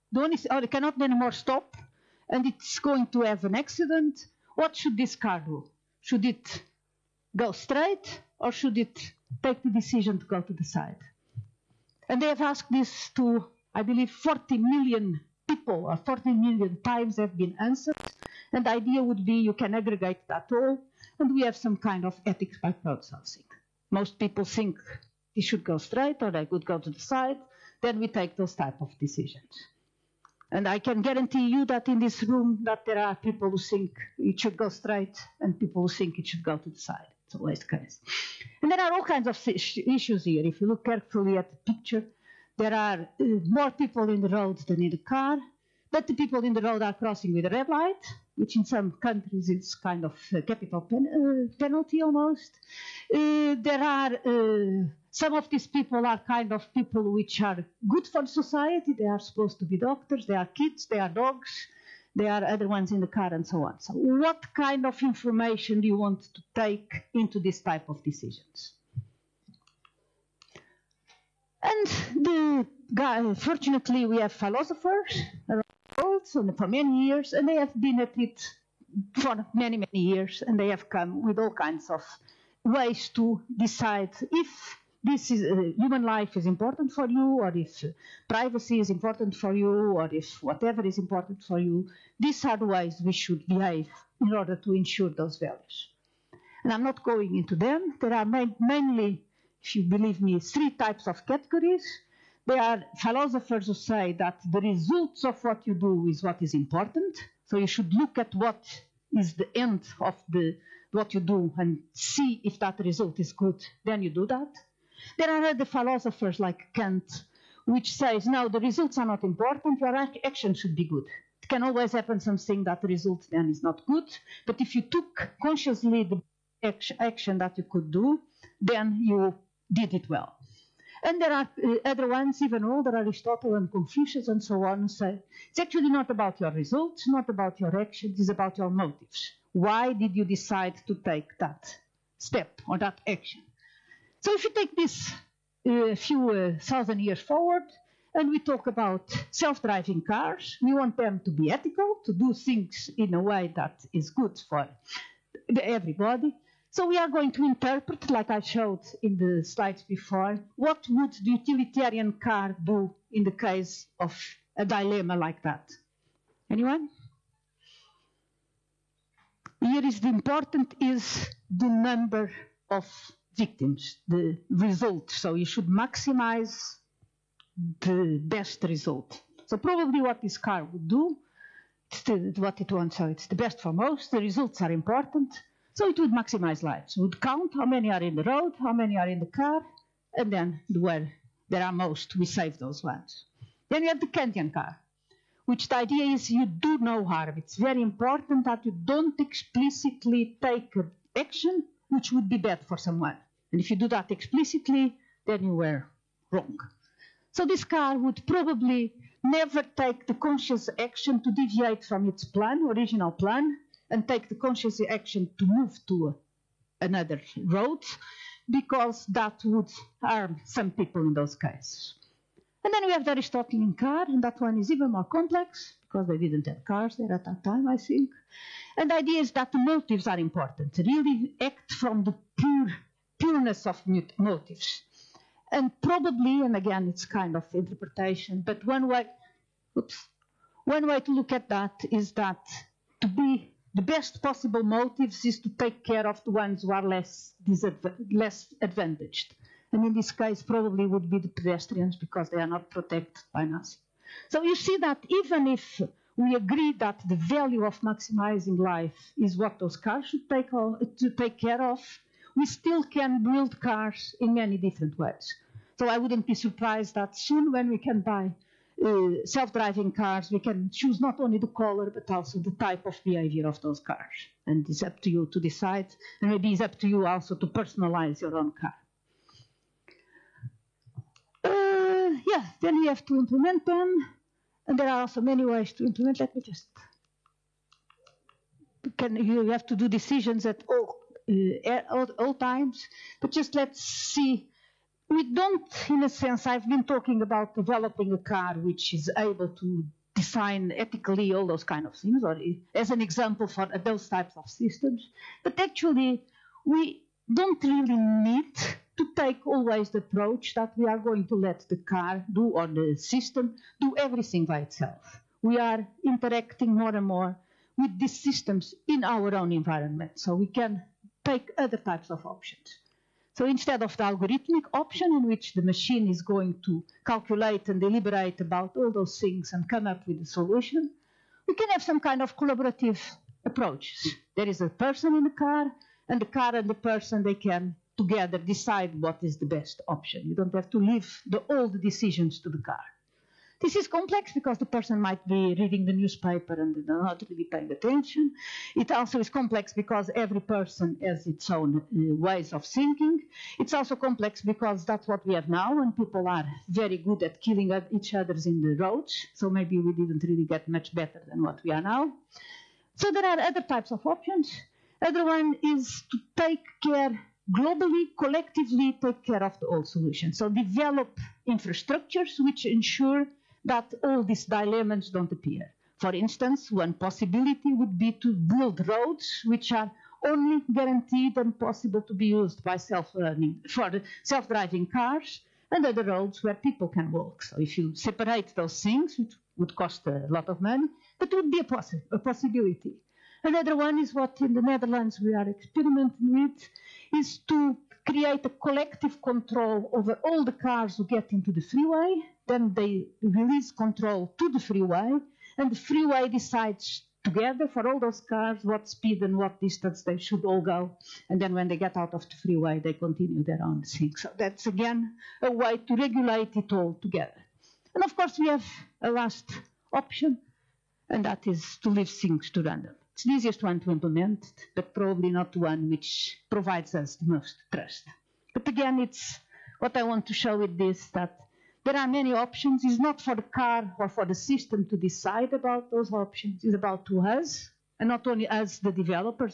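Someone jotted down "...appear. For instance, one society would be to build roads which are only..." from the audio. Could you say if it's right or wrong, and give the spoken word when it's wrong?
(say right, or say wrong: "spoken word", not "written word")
wrong: "possibility", not "society".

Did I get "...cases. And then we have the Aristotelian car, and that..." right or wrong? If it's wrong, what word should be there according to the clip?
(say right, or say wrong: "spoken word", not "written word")
right.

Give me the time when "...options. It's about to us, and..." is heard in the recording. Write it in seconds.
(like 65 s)
436 s.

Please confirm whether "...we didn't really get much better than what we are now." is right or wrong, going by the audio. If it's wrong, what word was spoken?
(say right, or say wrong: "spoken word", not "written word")
right.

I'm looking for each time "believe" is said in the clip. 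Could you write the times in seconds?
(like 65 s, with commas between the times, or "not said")
13 s, 99 s.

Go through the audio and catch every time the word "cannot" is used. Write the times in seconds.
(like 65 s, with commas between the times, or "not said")
0 s.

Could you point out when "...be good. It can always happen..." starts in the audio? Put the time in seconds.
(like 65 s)
120 s.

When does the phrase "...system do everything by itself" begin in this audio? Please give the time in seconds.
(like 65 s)
312 s.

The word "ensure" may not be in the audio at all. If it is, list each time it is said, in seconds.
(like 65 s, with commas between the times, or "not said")
94 s, 372 s.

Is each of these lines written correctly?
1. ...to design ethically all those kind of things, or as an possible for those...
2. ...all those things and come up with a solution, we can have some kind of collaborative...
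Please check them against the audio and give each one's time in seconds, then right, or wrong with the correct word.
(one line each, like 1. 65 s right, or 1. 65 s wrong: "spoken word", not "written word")
1. 299 s wrong: "example", not "possible"
2. 328 s right.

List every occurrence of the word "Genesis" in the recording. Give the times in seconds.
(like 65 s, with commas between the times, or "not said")
not said.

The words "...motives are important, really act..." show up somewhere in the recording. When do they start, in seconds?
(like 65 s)
229 s.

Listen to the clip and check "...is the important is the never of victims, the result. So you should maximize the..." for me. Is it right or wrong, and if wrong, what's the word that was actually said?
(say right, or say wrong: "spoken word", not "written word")
wrong: "number", not "never".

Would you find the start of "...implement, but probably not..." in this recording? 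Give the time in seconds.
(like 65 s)
423 s.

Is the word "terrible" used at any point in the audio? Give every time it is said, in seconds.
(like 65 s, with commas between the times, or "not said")
not said.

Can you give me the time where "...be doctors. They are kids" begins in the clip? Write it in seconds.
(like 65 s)
59 s.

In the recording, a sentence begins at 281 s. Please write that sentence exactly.
Uh, yeah, then you have to implement them, and there are also many ways to implement.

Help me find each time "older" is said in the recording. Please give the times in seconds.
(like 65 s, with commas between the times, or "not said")
132 s.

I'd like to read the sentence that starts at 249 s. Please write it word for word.
And in this case, probably would be the pedestrians because they are not protected by NASA.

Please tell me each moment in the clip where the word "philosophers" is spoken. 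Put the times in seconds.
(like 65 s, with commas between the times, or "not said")
74 s, 102 s, 115 s.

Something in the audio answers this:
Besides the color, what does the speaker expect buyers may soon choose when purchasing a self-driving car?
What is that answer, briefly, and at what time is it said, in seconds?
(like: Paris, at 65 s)
type of behavior, at 272 s.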